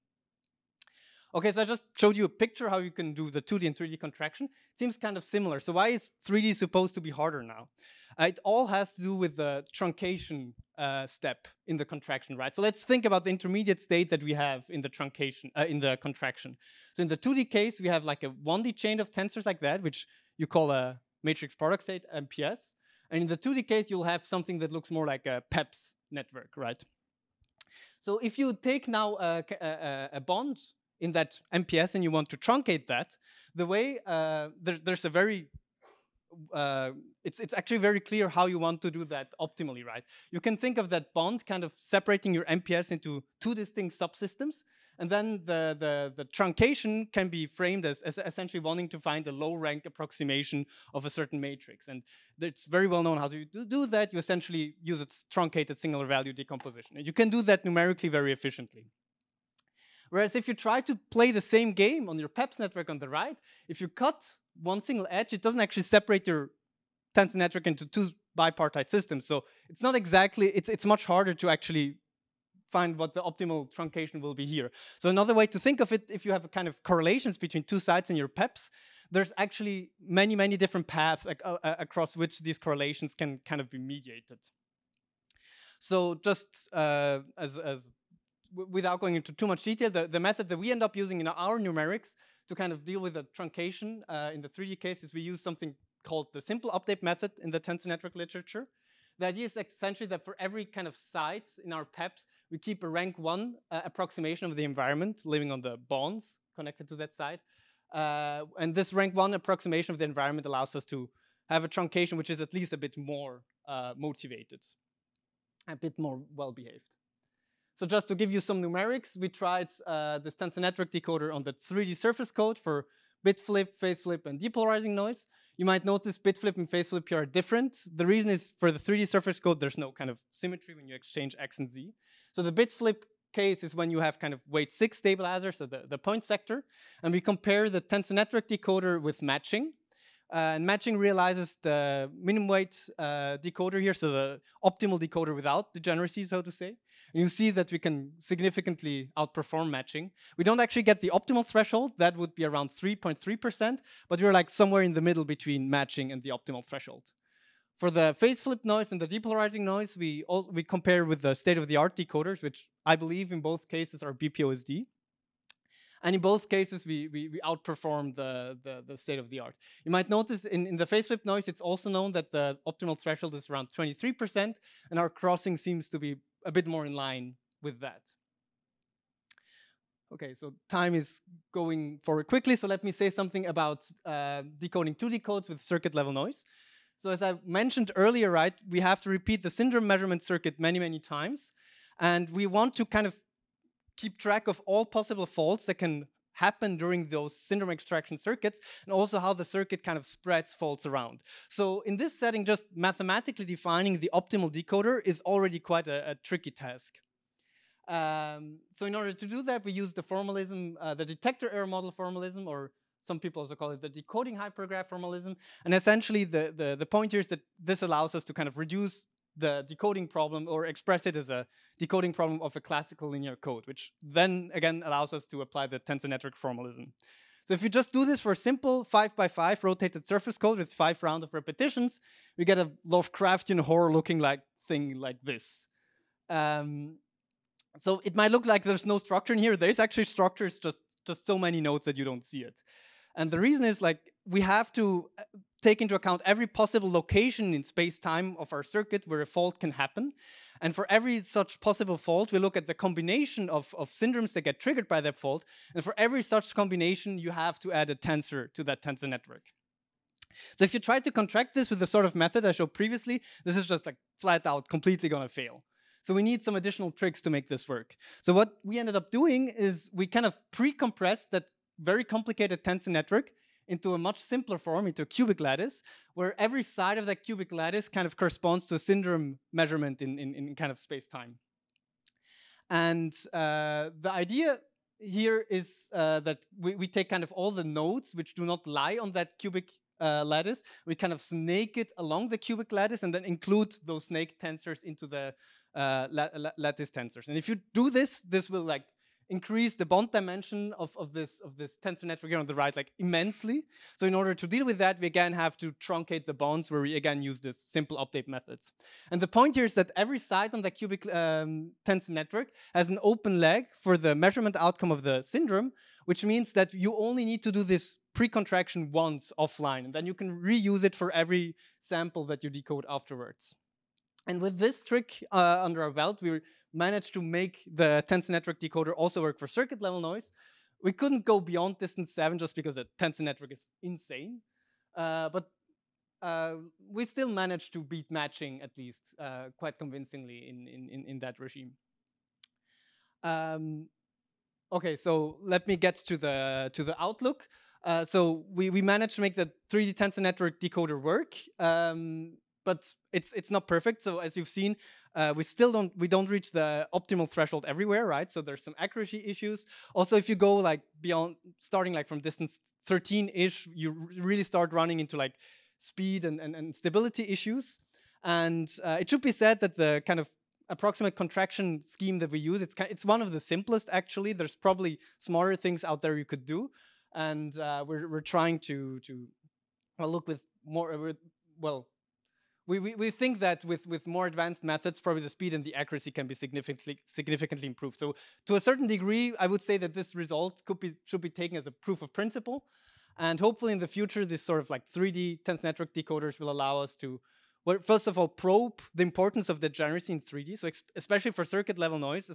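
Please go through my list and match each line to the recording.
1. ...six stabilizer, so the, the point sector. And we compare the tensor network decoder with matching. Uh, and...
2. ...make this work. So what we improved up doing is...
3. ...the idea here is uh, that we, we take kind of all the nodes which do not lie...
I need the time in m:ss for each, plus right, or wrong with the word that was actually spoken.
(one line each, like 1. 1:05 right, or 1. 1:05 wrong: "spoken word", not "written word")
1. 2:14 right
2. 4:27 wrong: "ended", not "improved"
3. 4:43 right.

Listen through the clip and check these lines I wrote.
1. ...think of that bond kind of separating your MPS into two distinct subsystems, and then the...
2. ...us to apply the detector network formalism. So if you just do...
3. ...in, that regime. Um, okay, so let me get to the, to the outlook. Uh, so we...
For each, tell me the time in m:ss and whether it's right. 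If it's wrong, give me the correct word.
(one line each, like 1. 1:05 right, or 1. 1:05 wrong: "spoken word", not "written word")
1. 0:40 right
2. 3:45 wrong: "tensor", not "detector"
3. 5:41 right.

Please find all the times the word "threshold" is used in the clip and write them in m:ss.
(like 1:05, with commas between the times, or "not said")
2:31, 2:36, 2:52, 5:57.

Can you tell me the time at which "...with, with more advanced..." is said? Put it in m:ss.
6:23.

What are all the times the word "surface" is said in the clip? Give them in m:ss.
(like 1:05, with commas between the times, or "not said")
2:01, 2:09, 3:50.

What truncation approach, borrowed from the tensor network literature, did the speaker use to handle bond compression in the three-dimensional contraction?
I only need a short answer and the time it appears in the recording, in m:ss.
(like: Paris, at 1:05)
Simple update method, at 1:36.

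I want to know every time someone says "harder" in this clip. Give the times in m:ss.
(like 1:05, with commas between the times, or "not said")
0:07, 1:11.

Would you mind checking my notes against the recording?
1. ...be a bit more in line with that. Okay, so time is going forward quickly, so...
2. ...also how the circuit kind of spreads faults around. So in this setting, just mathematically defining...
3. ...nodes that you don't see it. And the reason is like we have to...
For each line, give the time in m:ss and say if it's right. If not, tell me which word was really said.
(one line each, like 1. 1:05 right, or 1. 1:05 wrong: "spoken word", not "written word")
1. 2:55 right
2. 3:18 right
3. 4:01 right.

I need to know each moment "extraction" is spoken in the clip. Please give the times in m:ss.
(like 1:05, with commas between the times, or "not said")
3:17.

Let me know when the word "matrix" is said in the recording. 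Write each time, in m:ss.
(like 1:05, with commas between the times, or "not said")
0:21, 0:51.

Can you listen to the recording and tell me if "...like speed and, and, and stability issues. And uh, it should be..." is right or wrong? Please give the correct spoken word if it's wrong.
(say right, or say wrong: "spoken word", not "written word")
right.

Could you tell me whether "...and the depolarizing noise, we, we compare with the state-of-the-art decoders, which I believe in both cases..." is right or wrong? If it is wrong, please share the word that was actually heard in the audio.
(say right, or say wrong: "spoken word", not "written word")
right.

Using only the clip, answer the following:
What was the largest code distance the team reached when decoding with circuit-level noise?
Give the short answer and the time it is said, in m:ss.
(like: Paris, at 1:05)
7, at 5:31.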